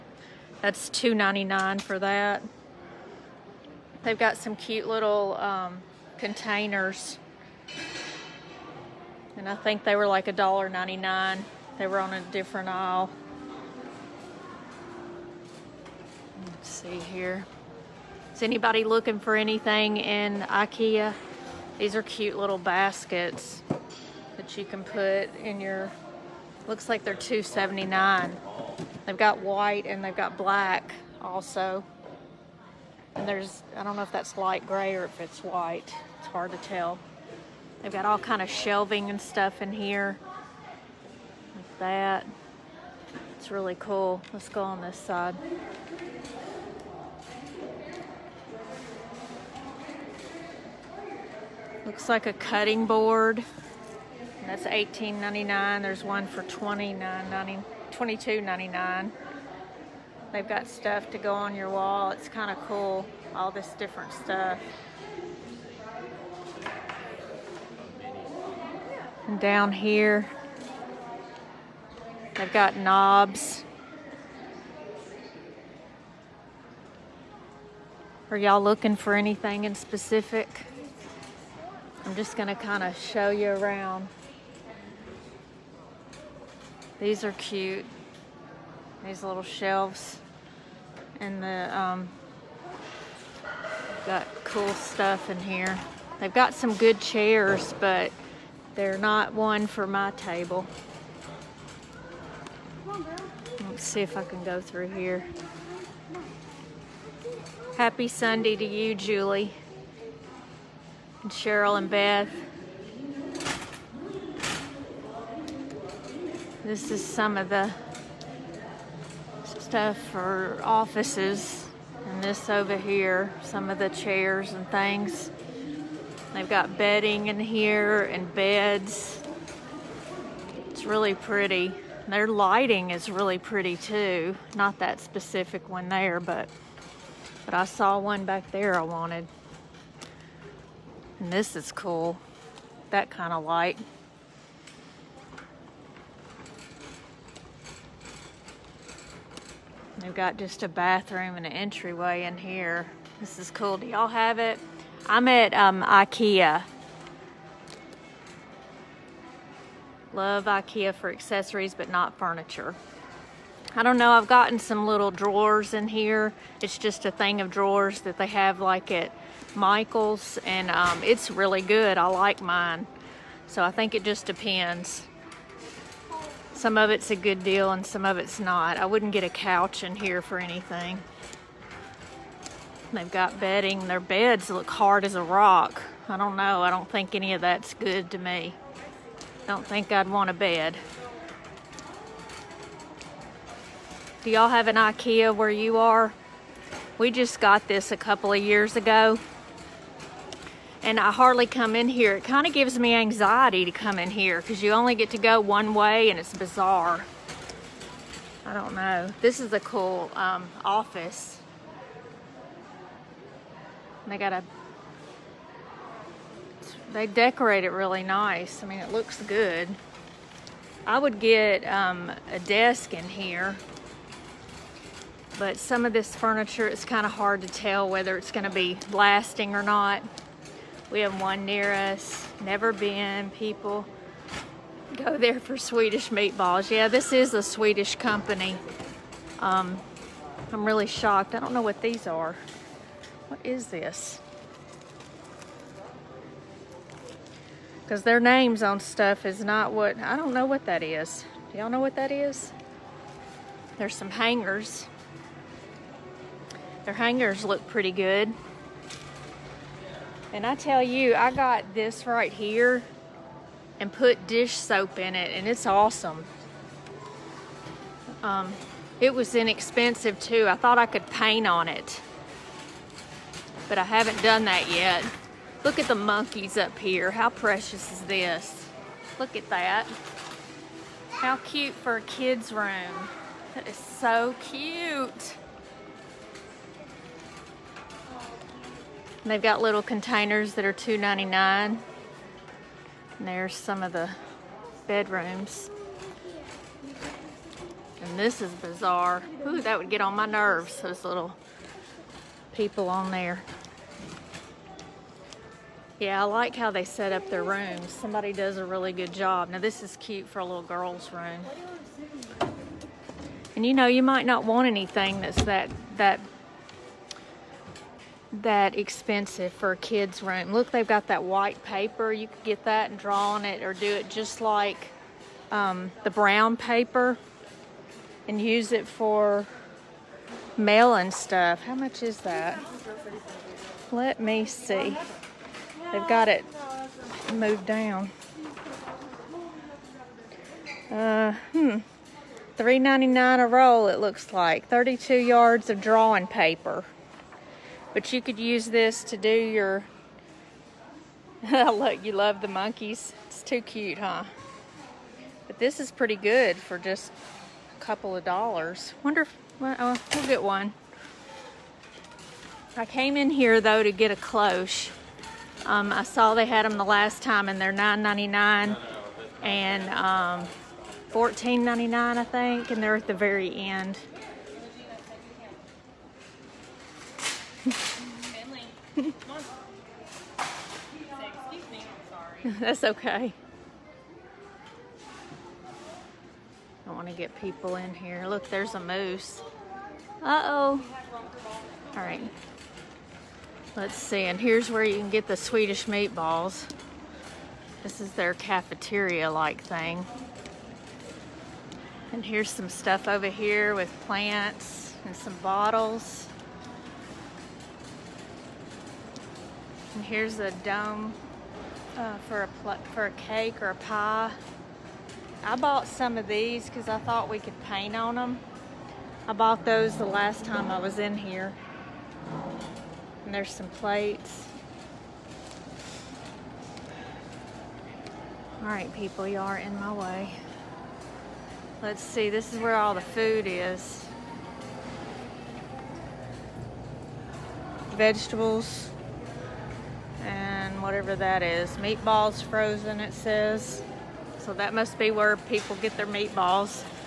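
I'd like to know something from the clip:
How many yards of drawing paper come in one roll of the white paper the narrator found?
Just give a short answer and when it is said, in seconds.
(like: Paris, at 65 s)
32 yards, at 344 s.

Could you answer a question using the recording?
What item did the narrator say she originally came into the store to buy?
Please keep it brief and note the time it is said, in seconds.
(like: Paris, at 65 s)
a cloche, at 364 s.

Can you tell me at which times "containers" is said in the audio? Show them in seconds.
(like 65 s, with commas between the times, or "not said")
6 s, 289 s.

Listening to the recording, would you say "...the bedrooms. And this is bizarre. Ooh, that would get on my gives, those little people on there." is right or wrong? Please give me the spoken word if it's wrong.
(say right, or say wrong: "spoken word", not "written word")
wrong: "nerves", not "gives".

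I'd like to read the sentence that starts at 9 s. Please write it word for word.
And I think they were like $1.99.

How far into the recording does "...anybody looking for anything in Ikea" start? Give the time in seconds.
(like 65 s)
18 s.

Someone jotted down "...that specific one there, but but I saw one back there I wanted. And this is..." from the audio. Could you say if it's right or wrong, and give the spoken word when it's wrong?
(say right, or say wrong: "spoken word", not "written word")
right.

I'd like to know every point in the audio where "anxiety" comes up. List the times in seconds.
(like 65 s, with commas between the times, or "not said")
202 s.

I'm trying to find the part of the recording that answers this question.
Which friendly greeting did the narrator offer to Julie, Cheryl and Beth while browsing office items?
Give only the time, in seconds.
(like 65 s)
107 s.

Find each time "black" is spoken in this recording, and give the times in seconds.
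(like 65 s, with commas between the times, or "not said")
30 s.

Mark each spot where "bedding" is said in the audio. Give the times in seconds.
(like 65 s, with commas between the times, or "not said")
126 s, 183 s.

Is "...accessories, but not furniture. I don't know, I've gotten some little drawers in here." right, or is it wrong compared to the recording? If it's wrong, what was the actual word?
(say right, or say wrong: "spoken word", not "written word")
right.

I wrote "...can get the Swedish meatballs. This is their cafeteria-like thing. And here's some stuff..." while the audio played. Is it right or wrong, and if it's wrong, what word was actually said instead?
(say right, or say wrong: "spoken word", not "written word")
right.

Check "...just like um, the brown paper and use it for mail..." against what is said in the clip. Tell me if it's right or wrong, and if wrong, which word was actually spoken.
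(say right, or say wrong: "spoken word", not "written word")
right.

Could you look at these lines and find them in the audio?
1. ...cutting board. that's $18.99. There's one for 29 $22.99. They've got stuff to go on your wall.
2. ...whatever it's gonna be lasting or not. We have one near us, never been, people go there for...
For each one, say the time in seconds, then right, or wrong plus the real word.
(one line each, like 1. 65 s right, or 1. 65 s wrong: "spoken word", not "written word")
1. 52 s right
2. 227 s wrong: "whether", not "whatever".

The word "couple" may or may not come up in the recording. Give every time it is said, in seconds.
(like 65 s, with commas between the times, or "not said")
197 s, 357 s.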